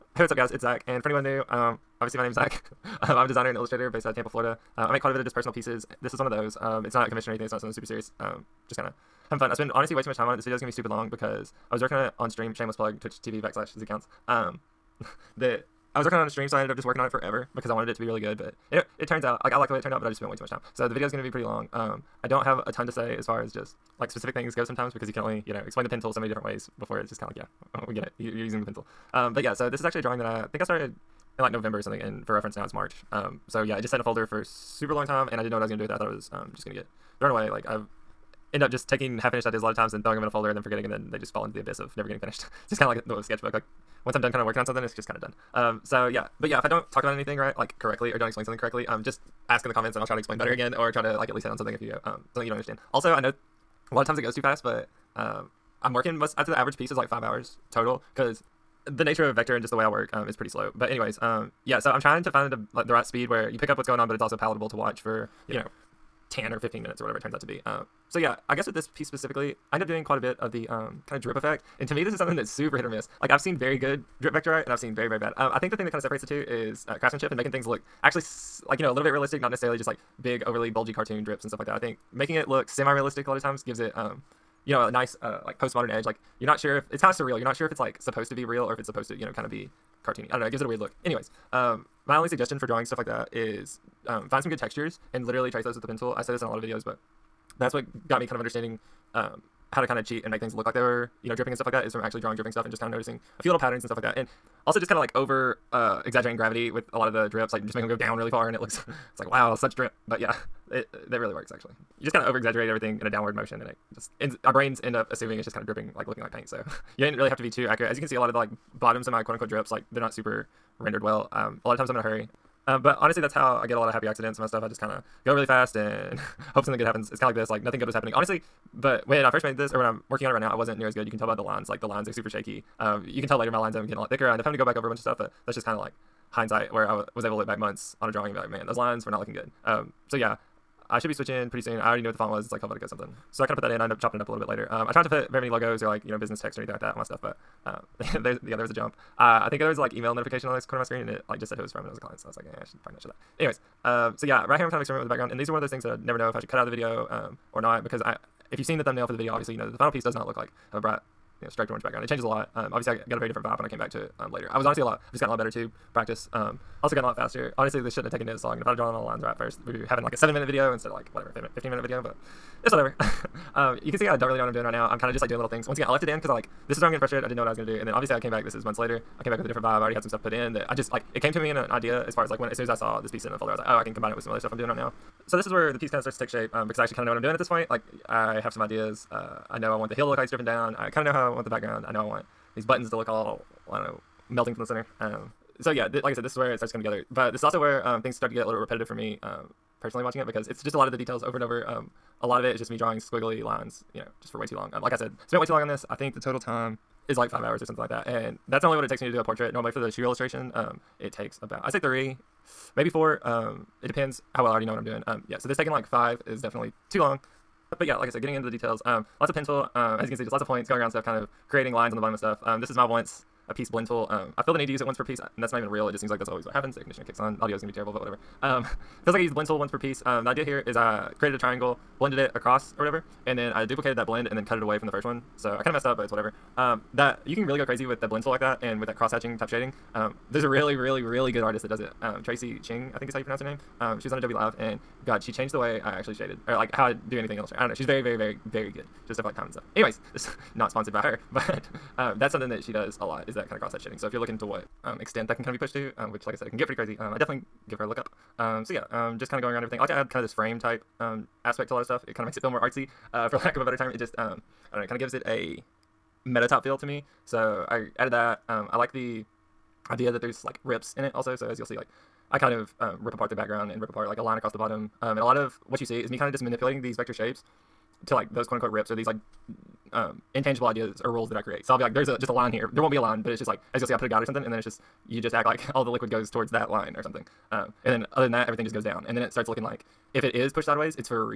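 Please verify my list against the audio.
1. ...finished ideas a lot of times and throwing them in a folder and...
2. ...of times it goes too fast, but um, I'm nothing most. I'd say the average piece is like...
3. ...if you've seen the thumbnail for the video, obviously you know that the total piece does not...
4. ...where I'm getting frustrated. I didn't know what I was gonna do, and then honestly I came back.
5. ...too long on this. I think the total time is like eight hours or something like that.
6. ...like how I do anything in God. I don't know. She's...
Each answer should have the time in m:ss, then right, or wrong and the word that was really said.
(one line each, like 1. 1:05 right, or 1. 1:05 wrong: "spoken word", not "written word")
1. 0:39 right
2. 0:54 wrong: "working", not "nothing"
3. 2:38 wrong: "final", not "total"
4. 2:56 wrong: "obviously", not "honestly"
5. 3:25 wrong: "five", not "eight"
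6. 4:06 wrong: "Illustrator", not "God".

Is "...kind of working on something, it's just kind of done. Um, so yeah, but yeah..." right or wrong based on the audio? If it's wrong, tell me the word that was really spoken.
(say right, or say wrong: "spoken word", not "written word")
right.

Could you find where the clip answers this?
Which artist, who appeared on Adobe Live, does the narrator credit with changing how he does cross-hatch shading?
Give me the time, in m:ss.
4:02.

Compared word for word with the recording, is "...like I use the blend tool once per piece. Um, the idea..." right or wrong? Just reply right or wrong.
right.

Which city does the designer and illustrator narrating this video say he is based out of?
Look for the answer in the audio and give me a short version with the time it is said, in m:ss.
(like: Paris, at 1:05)
Tampa, Florida, at 0:04.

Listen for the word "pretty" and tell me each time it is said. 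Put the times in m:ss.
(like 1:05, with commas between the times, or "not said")
0:21, 1:00, 2:21, 4:16.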